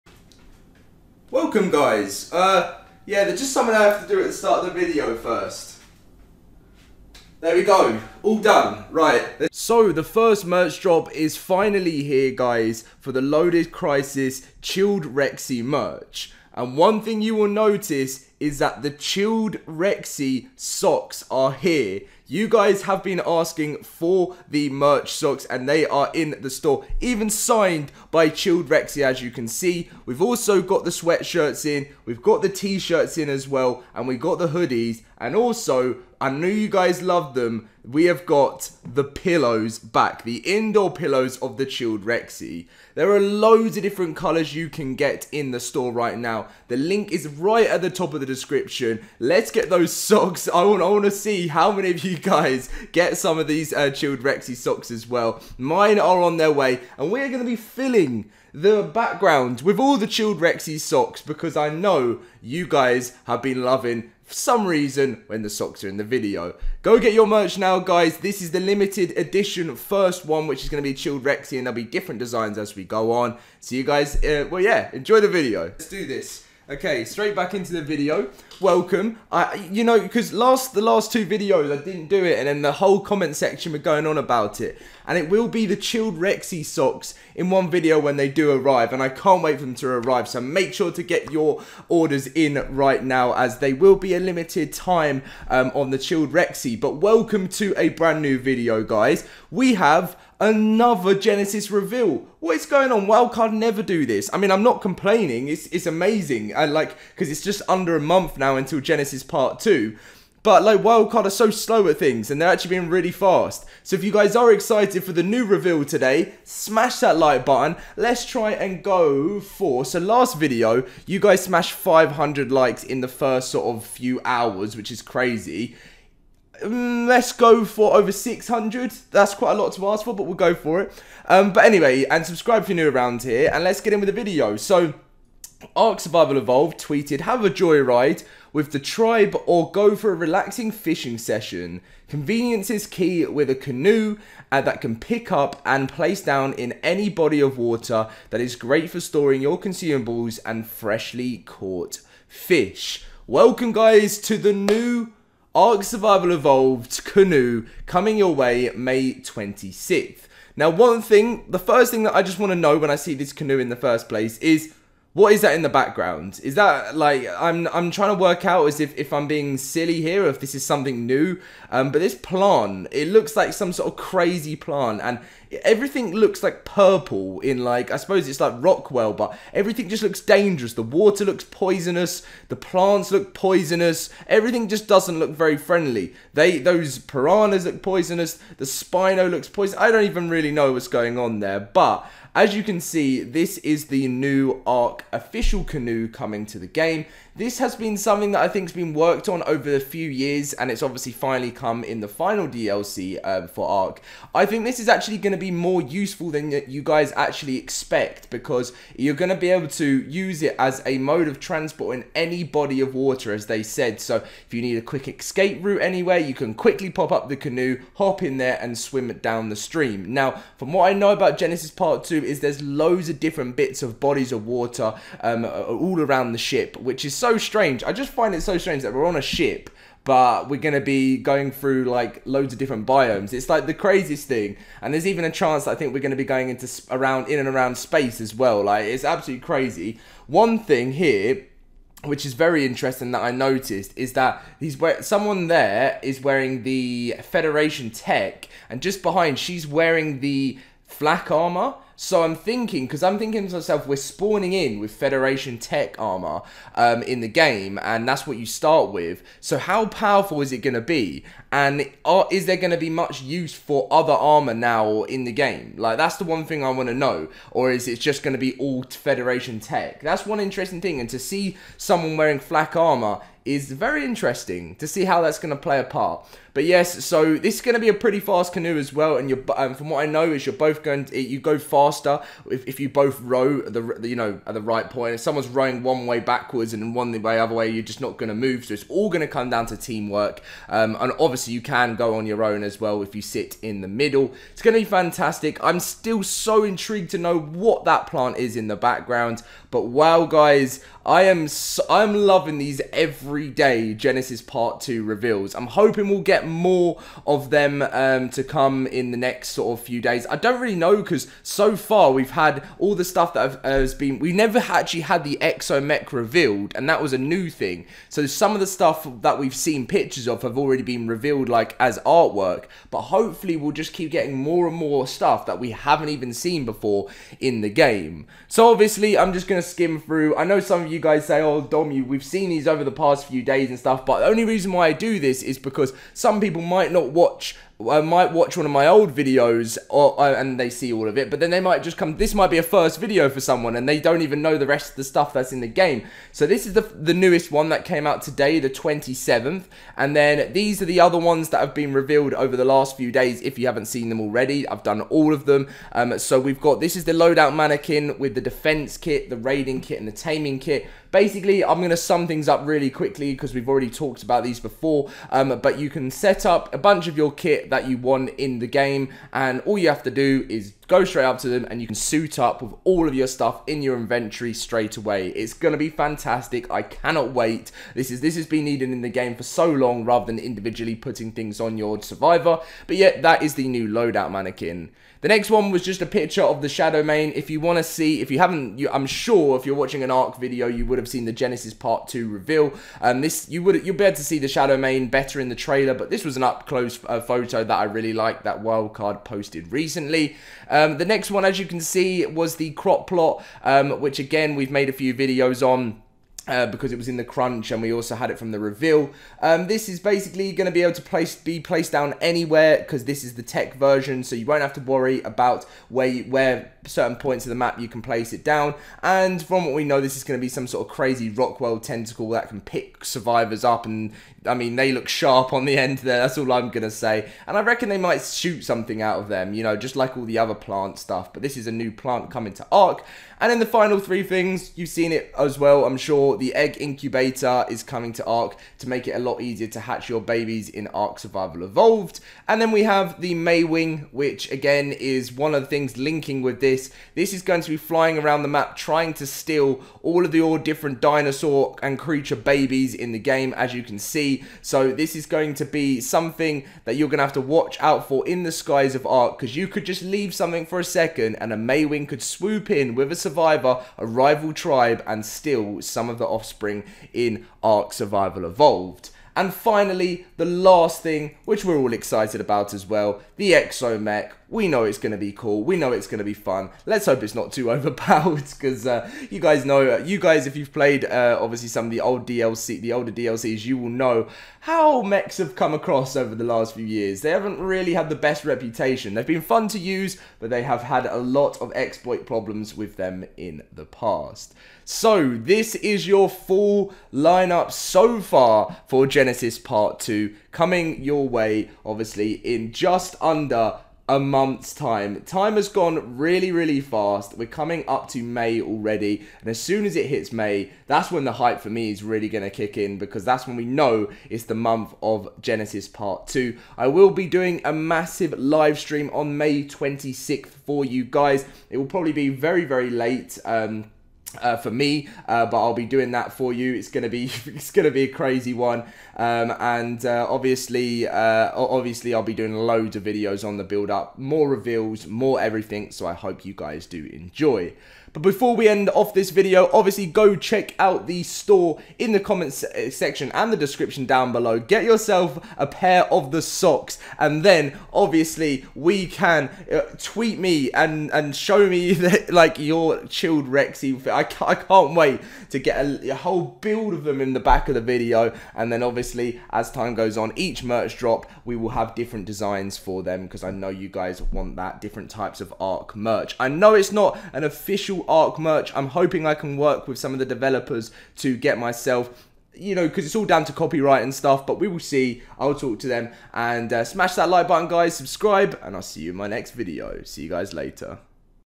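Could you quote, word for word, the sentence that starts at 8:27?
We're coming up to May already.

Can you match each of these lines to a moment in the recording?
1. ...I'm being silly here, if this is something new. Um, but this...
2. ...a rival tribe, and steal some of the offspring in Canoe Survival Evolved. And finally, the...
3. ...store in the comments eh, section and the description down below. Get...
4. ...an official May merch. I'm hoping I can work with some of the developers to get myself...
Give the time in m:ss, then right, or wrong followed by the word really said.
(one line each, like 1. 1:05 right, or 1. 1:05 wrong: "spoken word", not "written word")
1. 2:49 right
2. 7:43 wrong: "Ark", not "Canoe"
3. 9:01 right
4. 9:27 wrong: "Ark", not "May".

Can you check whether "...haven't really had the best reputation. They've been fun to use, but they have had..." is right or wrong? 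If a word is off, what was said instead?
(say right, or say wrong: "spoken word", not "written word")
right.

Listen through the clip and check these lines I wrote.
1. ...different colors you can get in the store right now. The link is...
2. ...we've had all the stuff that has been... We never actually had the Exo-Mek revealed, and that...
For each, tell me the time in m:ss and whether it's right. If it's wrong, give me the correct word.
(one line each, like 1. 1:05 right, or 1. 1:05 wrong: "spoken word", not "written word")
1. 0:43 right
2. 5:12 right.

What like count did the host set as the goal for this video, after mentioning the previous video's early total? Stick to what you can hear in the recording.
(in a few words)
600.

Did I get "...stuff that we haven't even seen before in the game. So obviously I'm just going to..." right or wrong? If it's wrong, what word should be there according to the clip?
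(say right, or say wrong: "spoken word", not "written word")
right.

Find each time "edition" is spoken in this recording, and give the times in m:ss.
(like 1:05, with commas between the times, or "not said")
1:09.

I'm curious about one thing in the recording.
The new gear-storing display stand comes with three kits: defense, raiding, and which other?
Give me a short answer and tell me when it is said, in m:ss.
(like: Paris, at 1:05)
Taming kit, at 6:00.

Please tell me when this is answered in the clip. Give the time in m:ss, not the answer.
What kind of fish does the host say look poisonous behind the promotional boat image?
3:06.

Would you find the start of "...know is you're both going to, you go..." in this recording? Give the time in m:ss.
4:40.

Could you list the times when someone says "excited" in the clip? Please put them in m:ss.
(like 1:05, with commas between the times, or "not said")
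1:54, 7:51.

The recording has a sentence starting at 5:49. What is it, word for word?
And then these are the other ones that have been revealed over the last few days if you haven't seen them already.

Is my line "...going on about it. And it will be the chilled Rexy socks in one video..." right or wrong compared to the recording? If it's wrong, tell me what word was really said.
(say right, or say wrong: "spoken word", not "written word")
right.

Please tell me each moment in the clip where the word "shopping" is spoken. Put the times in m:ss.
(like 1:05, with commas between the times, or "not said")
not said.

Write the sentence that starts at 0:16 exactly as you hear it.
And one thing you will notice is that the chilled Rexy socks are here.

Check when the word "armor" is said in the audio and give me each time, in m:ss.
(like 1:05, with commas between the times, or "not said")
4:11, 4:15, 4:24, 4:32.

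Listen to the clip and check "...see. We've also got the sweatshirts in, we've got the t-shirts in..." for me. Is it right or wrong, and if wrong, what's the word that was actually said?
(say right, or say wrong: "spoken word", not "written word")
right.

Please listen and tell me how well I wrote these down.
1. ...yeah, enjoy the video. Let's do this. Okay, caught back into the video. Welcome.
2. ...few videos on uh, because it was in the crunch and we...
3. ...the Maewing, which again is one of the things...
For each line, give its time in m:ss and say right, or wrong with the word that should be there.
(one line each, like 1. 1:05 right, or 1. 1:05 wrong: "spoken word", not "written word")
1. 1:14 wrong: "straight", not "caught"
2. 6:44 right
3. 7:23 right.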